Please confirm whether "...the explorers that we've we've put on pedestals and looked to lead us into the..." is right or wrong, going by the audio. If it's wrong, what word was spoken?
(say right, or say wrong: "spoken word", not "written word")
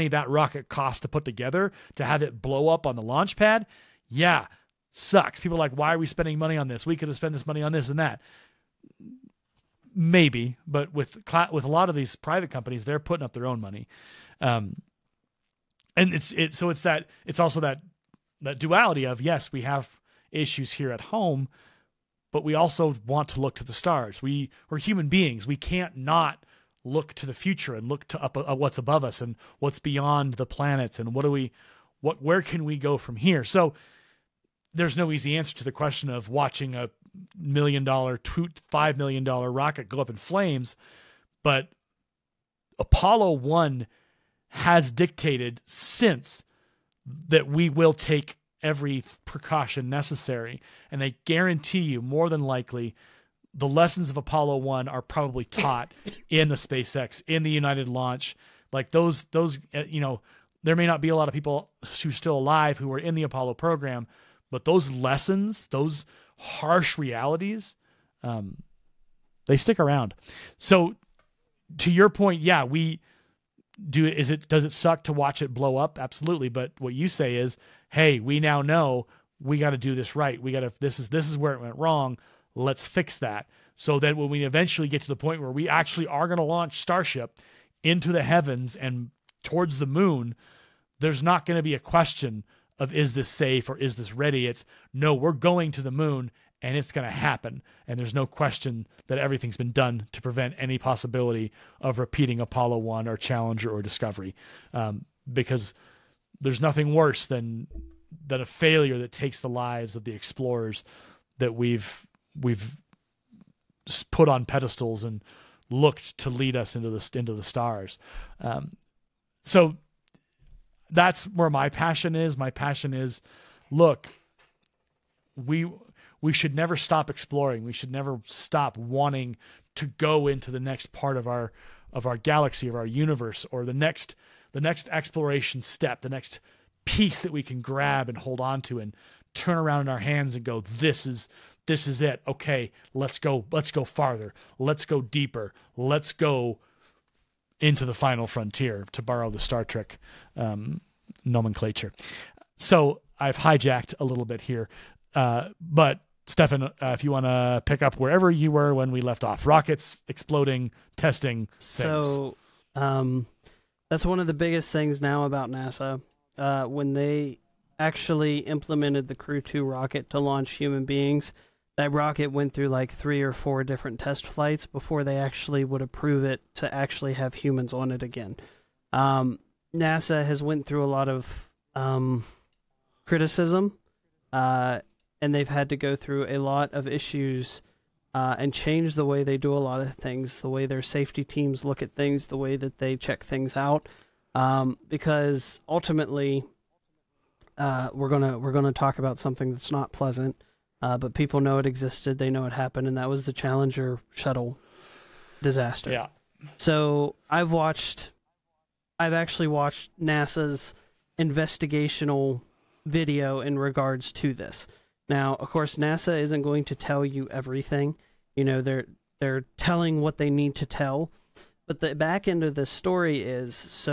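right.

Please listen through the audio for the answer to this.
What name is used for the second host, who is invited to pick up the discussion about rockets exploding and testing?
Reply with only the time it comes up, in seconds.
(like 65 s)
156 s.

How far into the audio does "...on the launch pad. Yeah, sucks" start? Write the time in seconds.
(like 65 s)
2 s.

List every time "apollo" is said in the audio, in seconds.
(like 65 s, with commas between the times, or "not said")
42 s, 54 s, 63 s, 102 s.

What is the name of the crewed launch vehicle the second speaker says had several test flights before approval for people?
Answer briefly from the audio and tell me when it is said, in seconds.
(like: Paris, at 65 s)
Crew 2, at 169 s.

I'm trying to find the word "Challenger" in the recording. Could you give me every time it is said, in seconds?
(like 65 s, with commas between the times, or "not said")
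103 s, 203 s.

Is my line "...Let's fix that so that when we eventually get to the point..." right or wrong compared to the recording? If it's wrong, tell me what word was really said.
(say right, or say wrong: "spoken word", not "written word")
right.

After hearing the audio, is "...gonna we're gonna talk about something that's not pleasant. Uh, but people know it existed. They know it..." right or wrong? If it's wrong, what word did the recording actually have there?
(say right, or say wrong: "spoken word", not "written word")
right.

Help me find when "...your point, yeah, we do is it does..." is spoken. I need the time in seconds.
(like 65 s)
71 s.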